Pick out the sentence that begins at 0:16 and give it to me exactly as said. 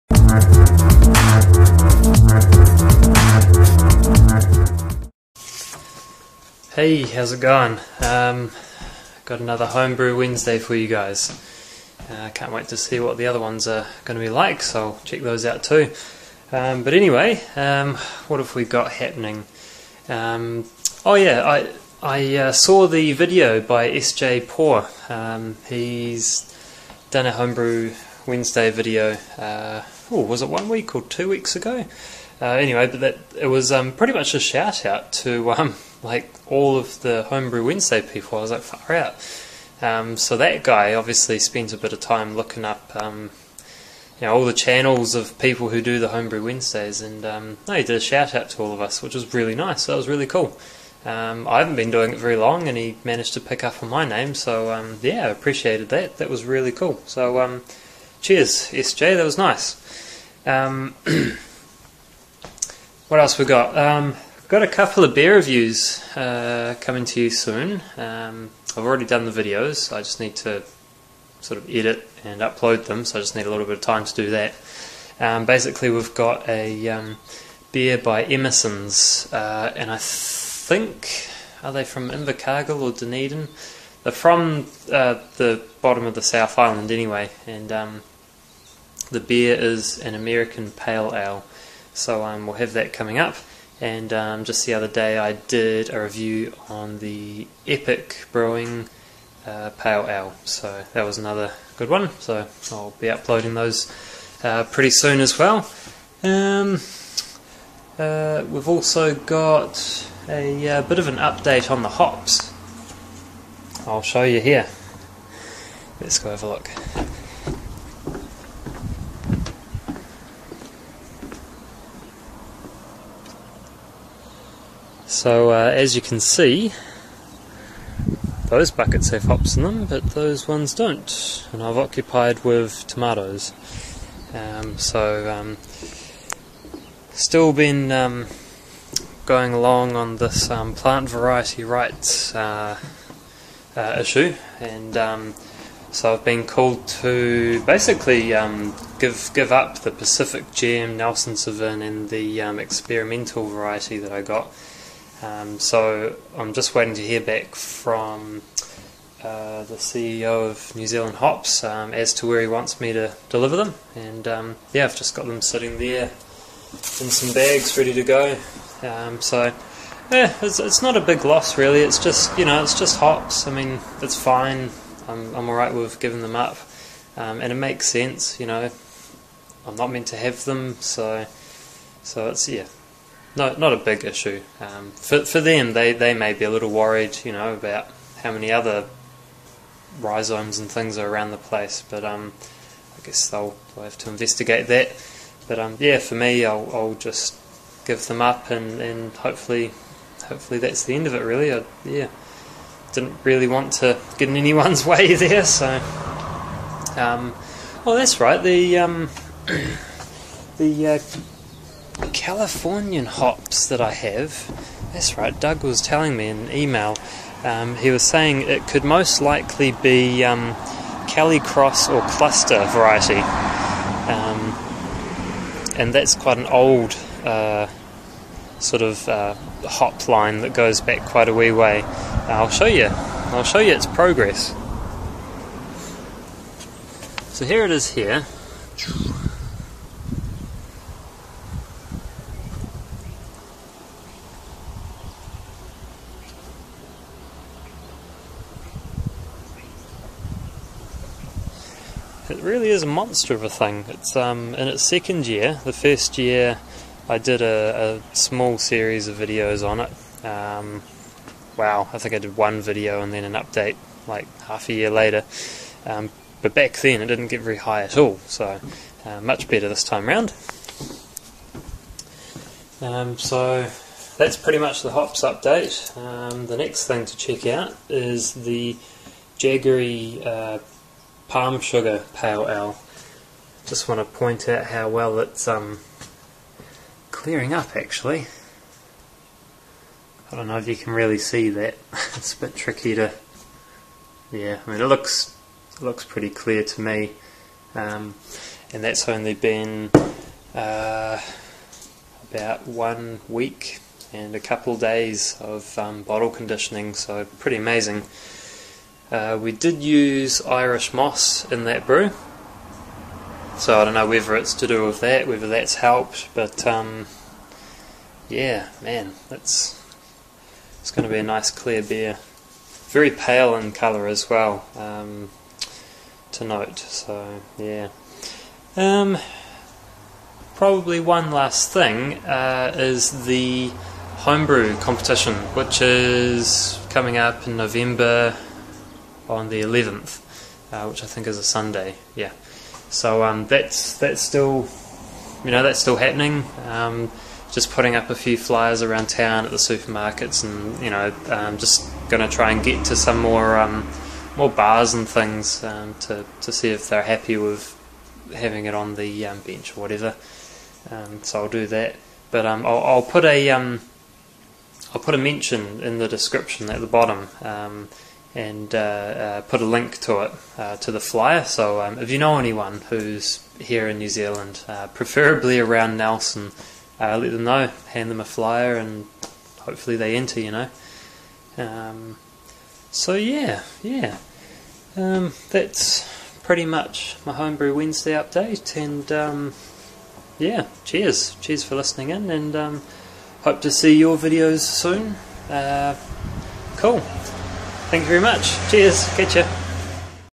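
Um, but anyway, um, what have we got happening?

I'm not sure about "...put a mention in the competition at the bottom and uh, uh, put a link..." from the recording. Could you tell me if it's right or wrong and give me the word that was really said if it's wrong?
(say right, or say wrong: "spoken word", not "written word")
wrong: "description", not "competition".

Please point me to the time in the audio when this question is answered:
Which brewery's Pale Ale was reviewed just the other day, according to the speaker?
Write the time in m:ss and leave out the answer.
1:37.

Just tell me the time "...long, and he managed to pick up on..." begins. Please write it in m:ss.
0:52.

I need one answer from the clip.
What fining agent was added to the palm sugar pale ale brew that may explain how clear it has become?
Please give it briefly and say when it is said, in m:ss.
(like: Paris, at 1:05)
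Irish moss, at 5:10.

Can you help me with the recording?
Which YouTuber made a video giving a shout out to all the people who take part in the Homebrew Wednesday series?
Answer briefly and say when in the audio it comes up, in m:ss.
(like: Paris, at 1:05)
SJ Porr, at 0:23.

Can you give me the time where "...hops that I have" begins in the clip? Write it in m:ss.
3:33.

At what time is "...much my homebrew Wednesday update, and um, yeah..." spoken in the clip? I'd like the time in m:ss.
6:26.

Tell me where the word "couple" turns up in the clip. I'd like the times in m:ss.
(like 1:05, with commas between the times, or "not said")
1:04, 5:04.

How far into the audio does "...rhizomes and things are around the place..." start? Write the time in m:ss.
3:09.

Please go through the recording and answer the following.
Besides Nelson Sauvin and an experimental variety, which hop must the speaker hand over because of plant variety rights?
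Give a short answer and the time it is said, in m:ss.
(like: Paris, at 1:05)
Pacific Gem, at 2:29.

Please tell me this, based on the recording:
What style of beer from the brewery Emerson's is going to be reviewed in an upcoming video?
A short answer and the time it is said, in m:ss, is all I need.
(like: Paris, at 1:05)
American Pale Ale, at 1:30.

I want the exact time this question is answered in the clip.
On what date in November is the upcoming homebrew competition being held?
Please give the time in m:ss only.
5:39.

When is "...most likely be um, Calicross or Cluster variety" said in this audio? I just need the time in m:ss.
3:38.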